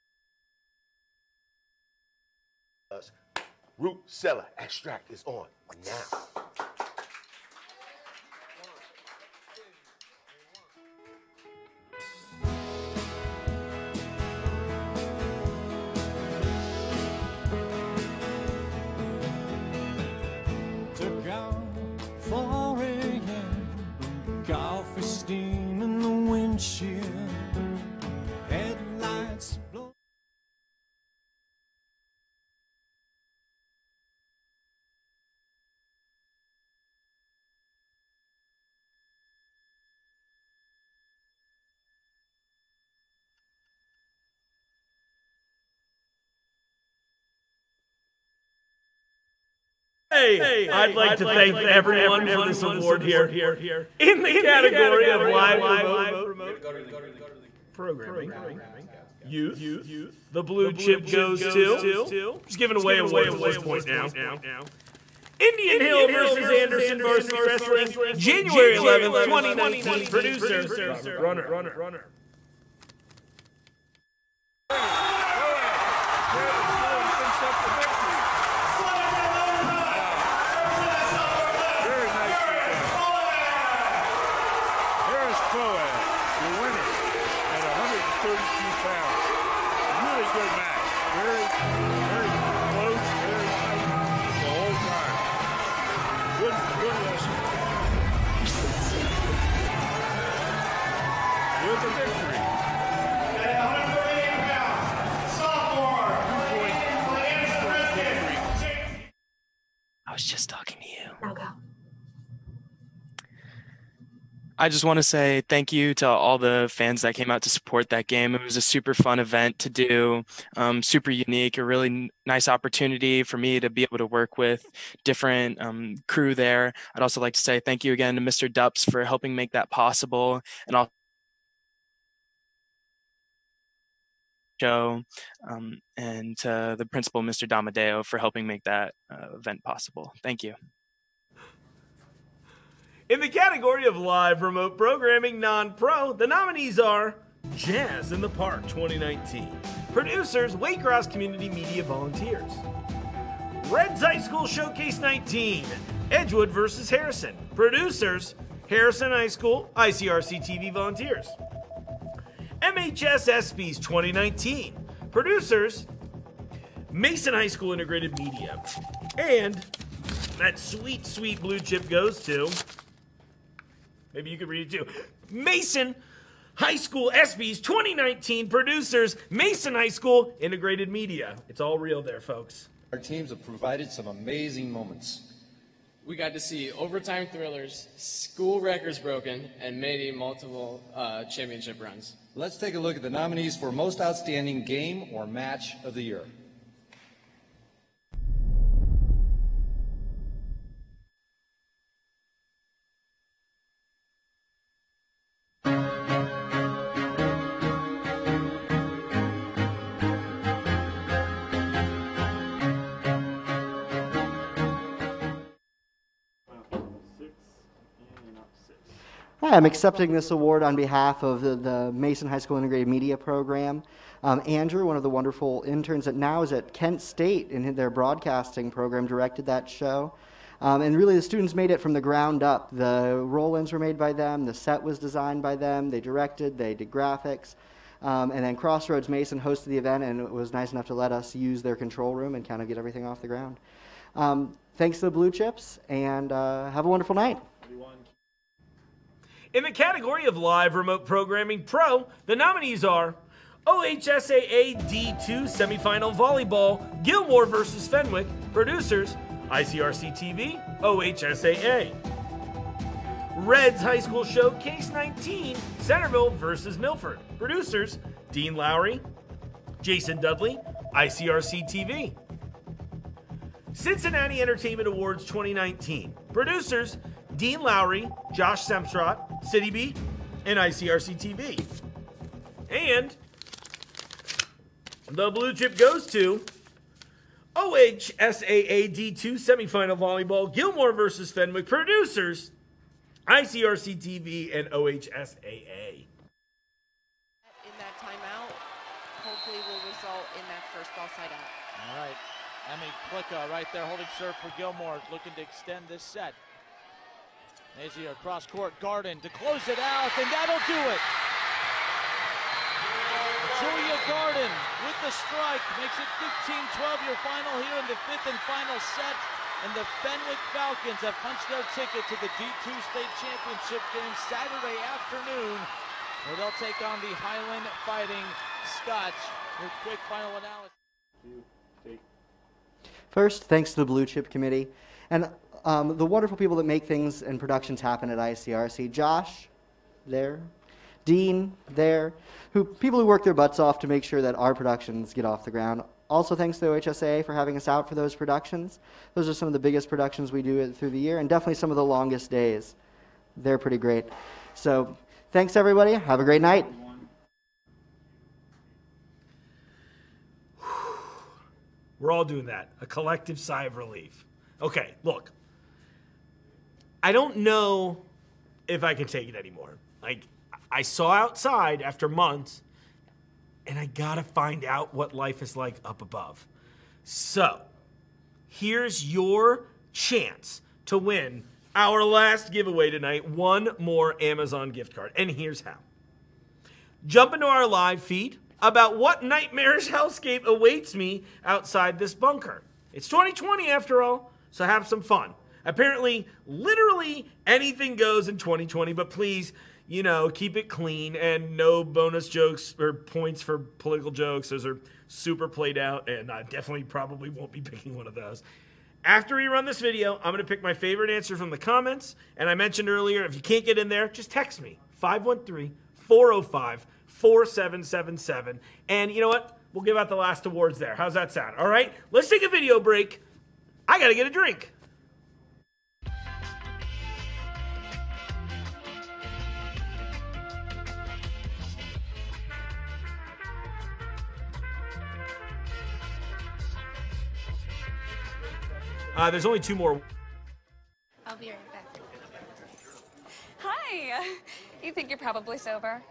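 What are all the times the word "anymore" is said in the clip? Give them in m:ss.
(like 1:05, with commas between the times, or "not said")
6:09.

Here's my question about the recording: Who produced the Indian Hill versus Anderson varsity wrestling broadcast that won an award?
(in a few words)
Robert Brunner.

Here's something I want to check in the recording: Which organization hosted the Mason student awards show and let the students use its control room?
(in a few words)
Crossroads Mason.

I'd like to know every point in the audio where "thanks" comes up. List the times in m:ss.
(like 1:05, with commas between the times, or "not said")
0:51, 1:55, 2:07, 2:20, 4:04, 5:33, 5:46, 5:55.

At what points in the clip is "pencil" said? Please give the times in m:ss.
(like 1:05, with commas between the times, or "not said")
not said.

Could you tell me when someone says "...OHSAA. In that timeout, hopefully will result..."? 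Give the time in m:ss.
4:54.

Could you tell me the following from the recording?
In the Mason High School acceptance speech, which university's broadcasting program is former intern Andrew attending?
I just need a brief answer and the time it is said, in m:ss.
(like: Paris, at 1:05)
Kent State, at 3:46.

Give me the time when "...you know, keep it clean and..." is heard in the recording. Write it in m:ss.
6:39.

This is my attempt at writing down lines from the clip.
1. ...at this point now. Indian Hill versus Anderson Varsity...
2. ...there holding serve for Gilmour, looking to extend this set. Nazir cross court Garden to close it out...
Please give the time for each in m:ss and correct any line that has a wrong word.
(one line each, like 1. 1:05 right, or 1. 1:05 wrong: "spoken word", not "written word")
1. 1:03 right
2. 5:03 right.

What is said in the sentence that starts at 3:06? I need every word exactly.
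We got to see overtime thrillers, school records broken, and many multiple uh, championship runs.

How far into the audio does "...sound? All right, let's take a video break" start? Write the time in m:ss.
7:01.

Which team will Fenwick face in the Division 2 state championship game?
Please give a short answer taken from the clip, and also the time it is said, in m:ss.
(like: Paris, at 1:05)
Highland Fighting Scots, at 5:27.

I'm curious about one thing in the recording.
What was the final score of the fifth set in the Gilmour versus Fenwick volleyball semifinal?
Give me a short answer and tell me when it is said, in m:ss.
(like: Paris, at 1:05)
15-12, at 5:16.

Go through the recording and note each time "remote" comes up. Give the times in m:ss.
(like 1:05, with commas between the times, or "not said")
0:55, 2:24, 4:10.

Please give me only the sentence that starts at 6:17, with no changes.
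So, here's your chance to win our last giveaway tonight one more Amazon gift card.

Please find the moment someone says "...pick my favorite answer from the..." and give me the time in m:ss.
6:50.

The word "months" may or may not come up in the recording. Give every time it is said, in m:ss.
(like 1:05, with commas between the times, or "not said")
6:12.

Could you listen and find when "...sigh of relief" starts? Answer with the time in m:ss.
6:03.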